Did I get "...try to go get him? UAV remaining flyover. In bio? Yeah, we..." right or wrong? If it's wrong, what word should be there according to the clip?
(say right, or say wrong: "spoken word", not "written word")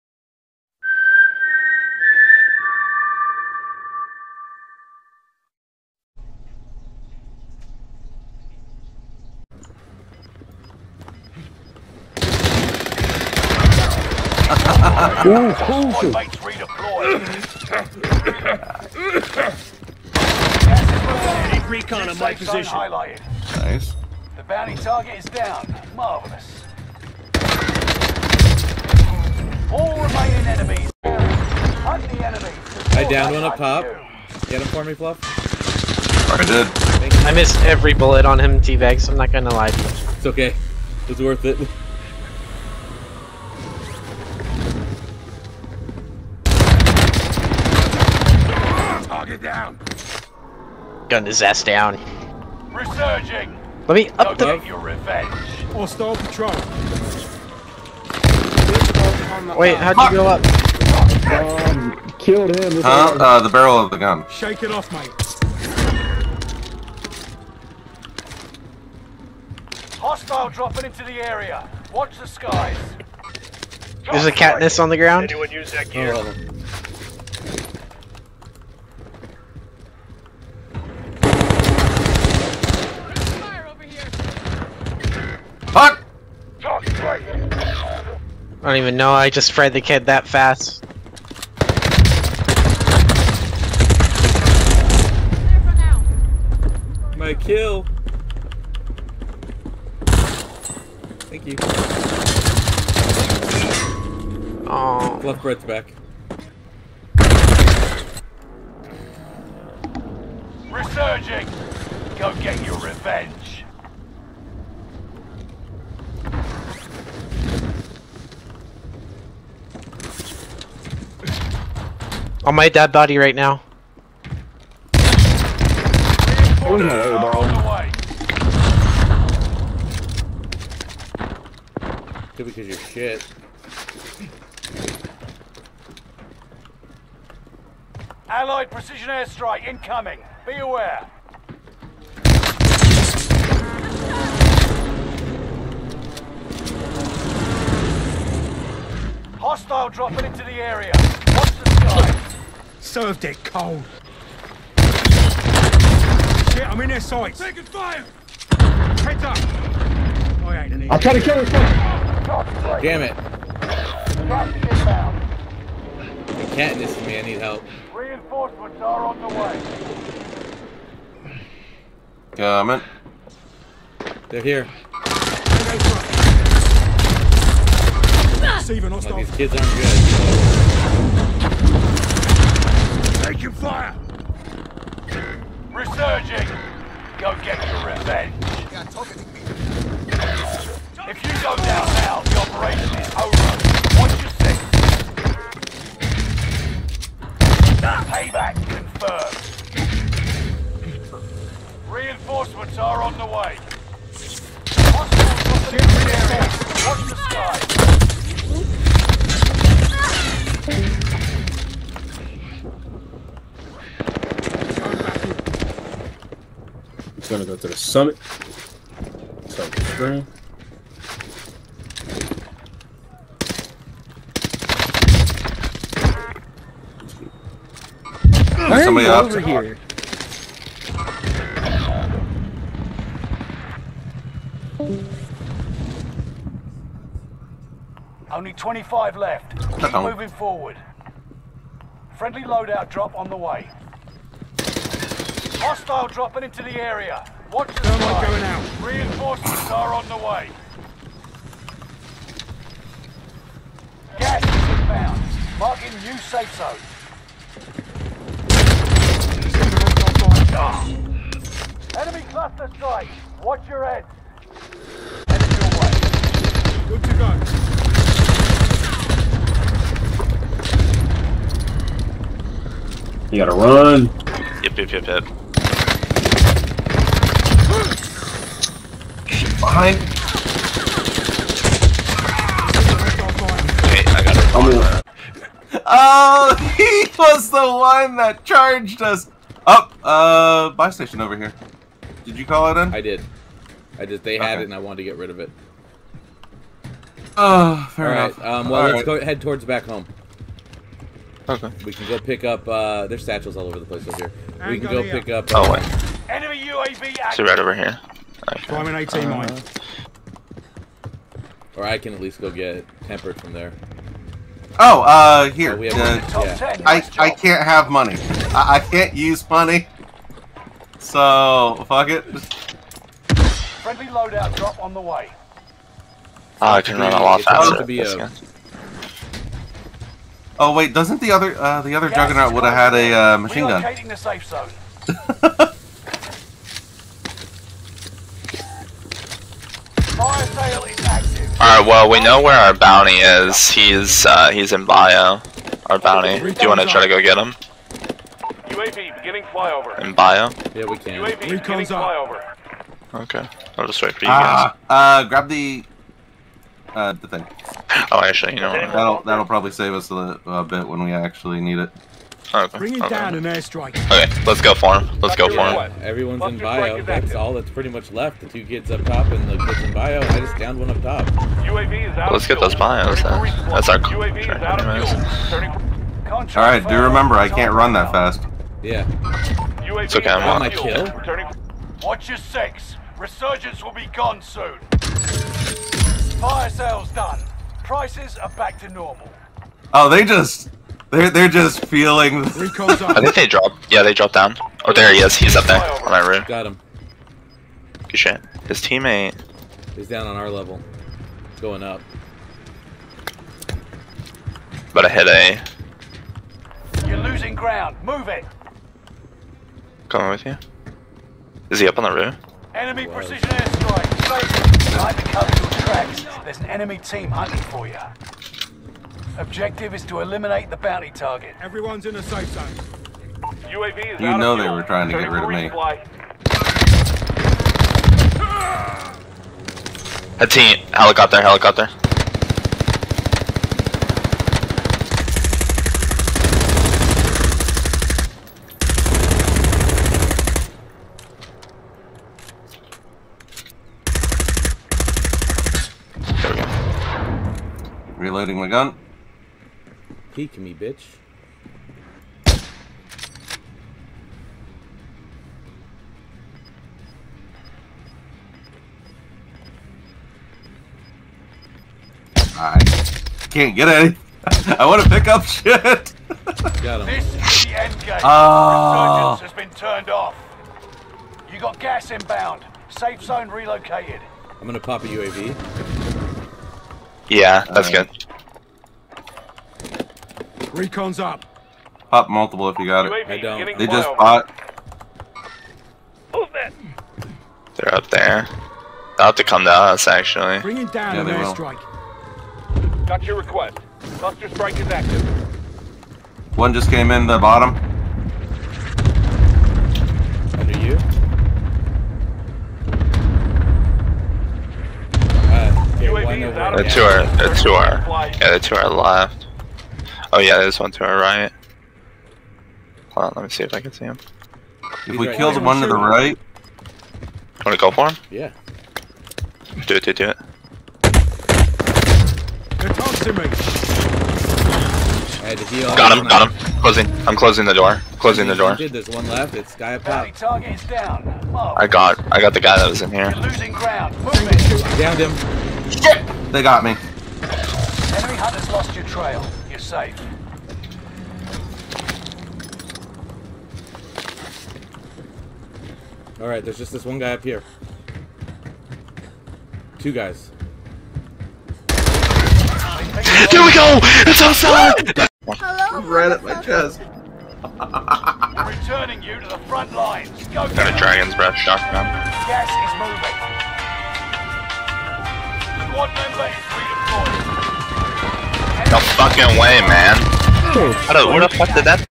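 wrong: "beginning", not "remaining".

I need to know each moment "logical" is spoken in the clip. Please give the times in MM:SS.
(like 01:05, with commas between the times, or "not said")
not said.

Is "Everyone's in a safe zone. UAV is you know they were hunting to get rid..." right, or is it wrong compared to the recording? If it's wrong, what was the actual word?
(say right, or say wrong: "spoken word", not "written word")
wrong: "trying", not "hunting".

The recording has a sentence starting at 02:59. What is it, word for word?
Well, these kids aren't good taking fire!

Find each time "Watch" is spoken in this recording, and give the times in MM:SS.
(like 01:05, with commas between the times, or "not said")
01:11, 03:13, 03:30, 04:07, 04:23, 06:22.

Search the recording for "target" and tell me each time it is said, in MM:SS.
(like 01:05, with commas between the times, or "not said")
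00:24, 07:01.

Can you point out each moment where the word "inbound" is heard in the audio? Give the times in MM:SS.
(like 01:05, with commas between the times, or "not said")
04:14, 07:52.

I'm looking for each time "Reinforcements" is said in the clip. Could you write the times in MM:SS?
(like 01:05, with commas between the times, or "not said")
02:47, 03:21, 04:08.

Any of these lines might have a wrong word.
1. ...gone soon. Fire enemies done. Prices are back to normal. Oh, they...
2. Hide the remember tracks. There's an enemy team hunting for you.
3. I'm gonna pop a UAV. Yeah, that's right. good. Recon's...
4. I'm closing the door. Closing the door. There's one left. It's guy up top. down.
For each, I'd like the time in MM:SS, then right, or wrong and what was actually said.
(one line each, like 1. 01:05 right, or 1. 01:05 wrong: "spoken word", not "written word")
1. 06:24 wrong: "sales", not "enemies"
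2. 06:54 wrong: "cover", not "remember"
3. 07:54 right
4. 08:47 right.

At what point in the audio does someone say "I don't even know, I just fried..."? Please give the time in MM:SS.
01:28.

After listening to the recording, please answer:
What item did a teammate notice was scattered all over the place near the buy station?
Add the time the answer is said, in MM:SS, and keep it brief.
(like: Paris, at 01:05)
satchels, at 05:03.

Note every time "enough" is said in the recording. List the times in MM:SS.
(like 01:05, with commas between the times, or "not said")
04:58.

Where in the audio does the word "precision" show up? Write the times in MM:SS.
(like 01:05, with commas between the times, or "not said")
02:18, 06:53.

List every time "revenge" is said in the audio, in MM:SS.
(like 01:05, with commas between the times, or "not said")
00:54, 01:52, 03:07.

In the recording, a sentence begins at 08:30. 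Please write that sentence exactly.
Oh yeah, there's one to our right.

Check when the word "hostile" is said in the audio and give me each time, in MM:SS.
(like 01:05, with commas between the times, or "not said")
01:09, 02:29, 02:58, 03:24, 04:05.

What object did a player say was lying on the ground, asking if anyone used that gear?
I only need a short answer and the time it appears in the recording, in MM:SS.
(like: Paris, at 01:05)
catnip, at 01:14.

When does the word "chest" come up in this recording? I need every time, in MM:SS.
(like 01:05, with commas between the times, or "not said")
09:16.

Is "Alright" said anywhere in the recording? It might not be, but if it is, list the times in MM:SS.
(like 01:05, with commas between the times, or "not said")
05:41, 09:06.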